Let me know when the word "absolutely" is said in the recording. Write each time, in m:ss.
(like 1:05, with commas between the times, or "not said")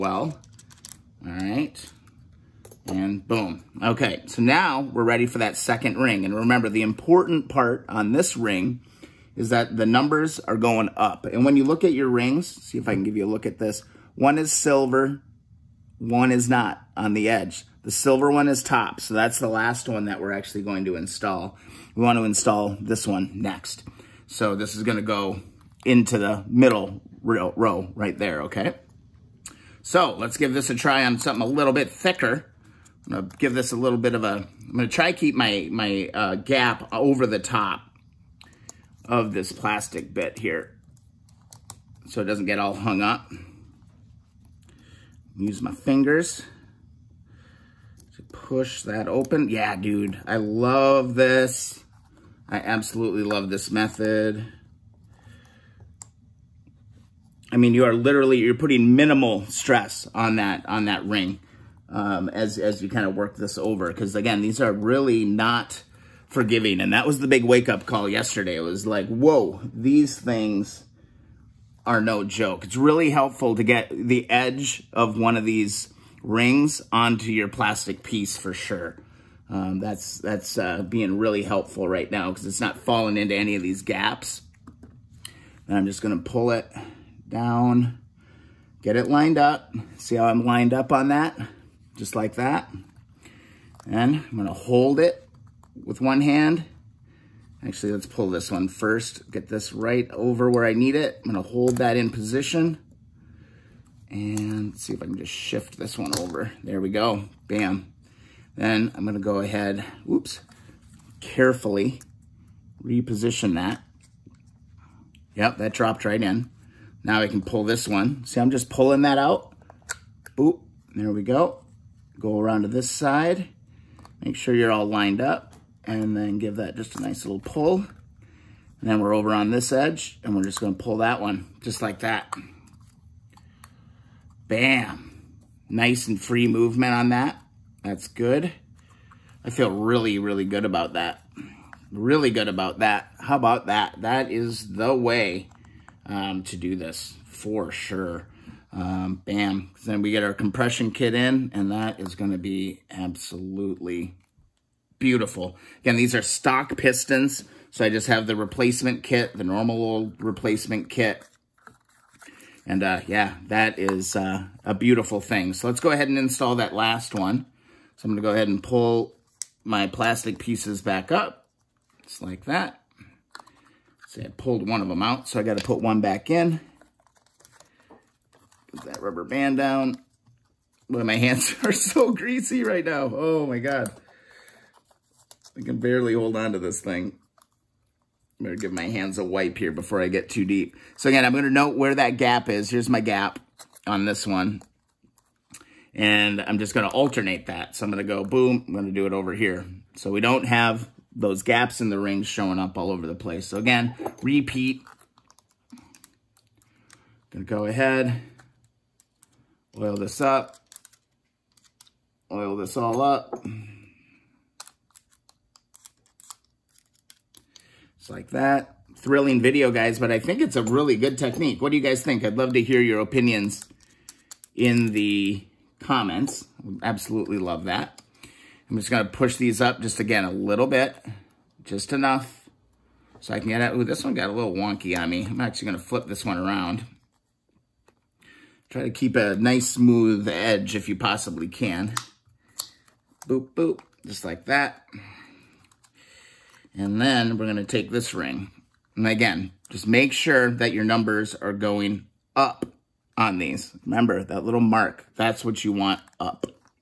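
0:52, 2:32, 3:46.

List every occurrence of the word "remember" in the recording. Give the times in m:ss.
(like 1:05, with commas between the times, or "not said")
0:06, 4:13.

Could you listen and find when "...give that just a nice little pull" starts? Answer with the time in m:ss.
2:06.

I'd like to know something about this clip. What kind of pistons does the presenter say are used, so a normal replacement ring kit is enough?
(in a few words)
Stock pistons.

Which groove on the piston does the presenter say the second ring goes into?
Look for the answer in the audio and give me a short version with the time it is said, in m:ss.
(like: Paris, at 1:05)
The middle row, at 0:26.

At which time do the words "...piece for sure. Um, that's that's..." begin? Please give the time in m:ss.
1:18.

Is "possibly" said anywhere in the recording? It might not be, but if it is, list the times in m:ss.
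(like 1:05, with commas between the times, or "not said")
4:00.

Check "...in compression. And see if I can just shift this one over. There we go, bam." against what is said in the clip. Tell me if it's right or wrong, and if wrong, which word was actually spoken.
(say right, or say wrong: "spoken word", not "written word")
wrong: "position", not "compression".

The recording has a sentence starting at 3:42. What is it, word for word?
I'd love to hear your opinions in the comments.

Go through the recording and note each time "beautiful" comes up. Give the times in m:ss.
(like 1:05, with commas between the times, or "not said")
2:34, 2:44.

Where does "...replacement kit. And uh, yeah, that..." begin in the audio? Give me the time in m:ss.
2:40.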